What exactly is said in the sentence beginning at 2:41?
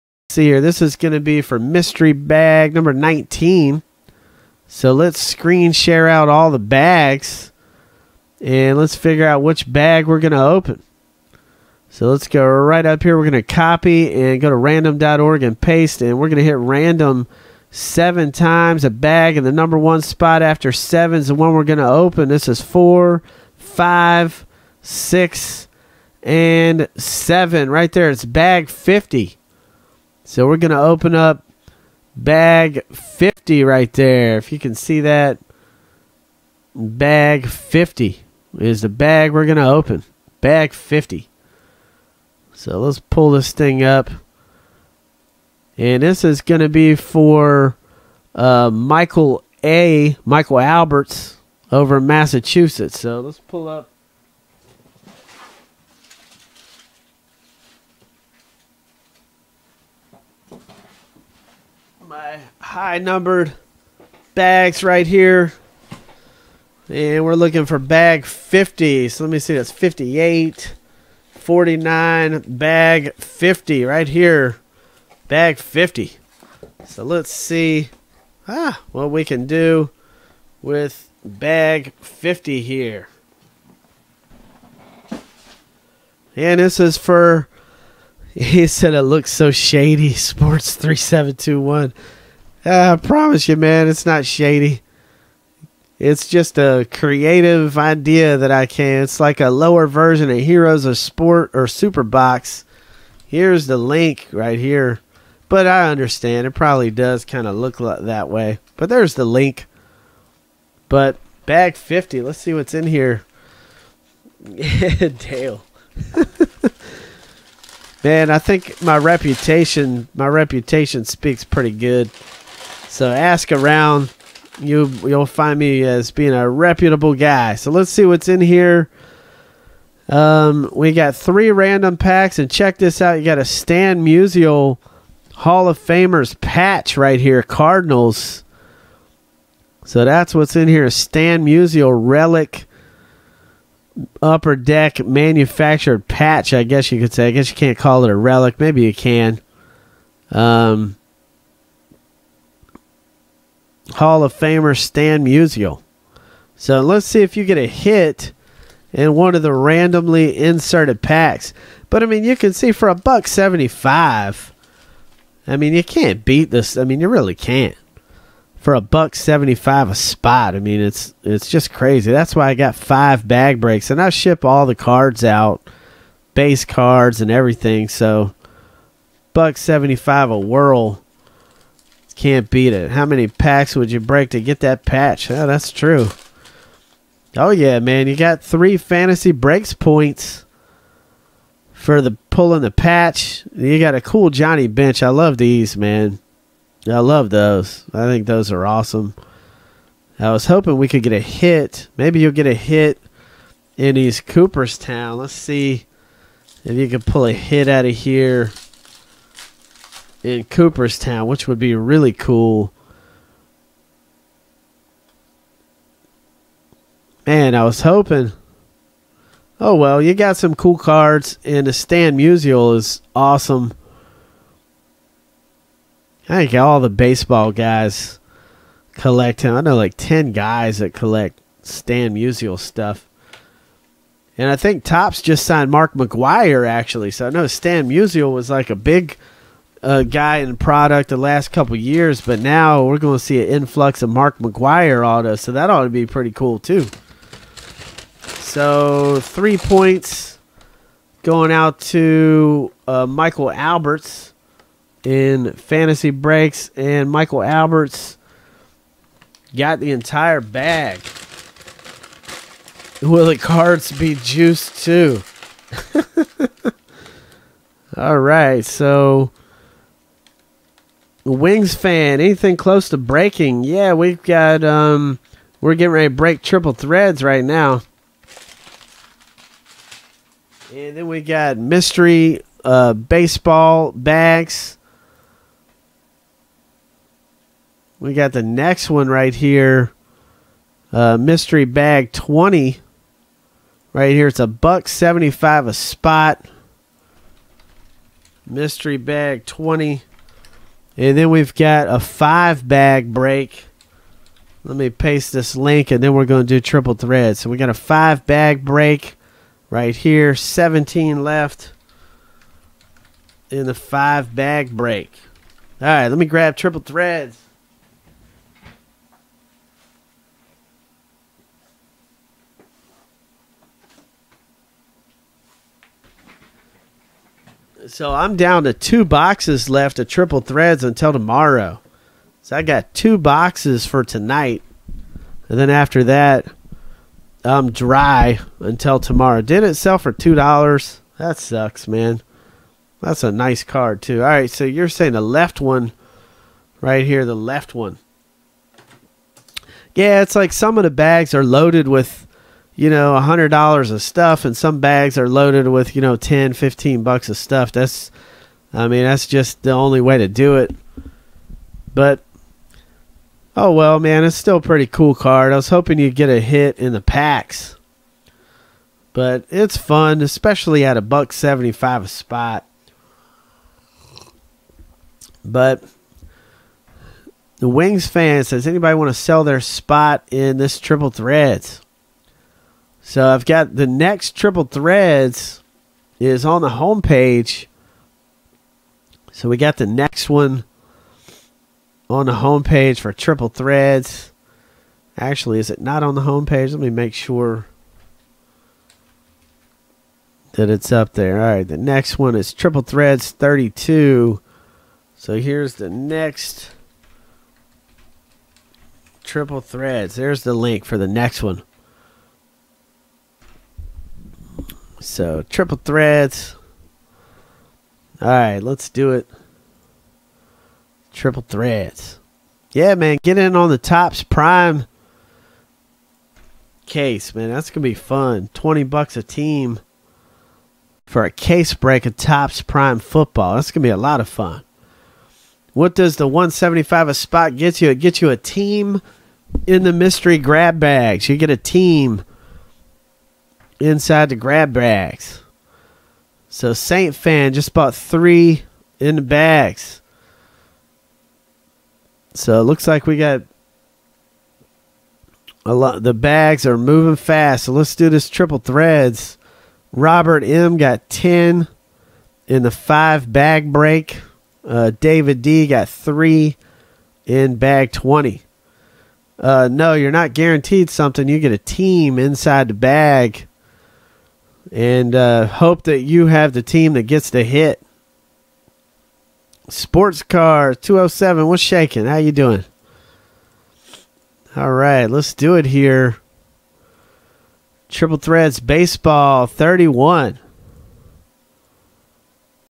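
But I mean, you can see for a buck seventy-five.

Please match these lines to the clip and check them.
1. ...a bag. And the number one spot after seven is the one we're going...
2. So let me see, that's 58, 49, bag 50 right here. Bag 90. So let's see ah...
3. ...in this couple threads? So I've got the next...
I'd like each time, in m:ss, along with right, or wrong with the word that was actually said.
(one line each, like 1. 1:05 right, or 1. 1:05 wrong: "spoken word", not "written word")
1. 0:18 right
2. 1:09 wrong: "50", not "90"
3. 6:20 wrong: "triple", not "couple".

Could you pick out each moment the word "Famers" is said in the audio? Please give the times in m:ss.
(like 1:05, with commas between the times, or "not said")
2:15, 2:34.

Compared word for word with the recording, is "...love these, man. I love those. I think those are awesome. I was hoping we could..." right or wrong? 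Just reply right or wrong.
right.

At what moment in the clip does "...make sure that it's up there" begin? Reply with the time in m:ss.
6:36.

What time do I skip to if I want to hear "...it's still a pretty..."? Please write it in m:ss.
6:04.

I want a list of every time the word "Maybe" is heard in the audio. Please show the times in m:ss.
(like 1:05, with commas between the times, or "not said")
2:28, 3:21.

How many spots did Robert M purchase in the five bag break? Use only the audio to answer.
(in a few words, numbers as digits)
10.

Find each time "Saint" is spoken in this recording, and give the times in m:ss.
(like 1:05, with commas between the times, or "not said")
7:26.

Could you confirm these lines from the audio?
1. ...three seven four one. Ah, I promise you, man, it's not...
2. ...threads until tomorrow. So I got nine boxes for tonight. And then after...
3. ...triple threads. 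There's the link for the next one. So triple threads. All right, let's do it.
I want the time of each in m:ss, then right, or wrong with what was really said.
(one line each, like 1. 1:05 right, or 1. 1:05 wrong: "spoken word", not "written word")
1. 1:30 wrong: "two", not "four"
2. 5:30 wrong: "two", not "nine"
3. 6:49 right.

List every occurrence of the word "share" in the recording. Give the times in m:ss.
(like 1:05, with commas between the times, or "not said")
0:05.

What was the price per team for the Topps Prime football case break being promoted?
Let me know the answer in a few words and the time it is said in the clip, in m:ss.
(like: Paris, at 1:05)
$20, at 7:08.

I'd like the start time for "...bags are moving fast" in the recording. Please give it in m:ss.
7:36.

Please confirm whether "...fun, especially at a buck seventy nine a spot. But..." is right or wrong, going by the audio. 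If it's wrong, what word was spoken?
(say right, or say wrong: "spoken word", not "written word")
wrong: "five", not "nine".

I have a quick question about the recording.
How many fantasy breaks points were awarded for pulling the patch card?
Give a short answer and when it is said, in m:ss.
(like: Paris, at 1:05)
3, at 3:08.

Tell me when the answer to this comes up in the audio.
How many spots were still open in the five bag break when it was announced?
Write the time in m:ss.
5:10.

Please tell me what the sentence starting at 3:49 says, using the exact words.
I know like 10 guys that collect Stan Musial stuff.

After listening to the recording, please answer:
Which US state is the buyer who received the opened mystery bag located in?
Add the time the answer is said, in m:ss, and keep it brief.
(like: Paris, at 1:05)
Massachusetts, at 0:52.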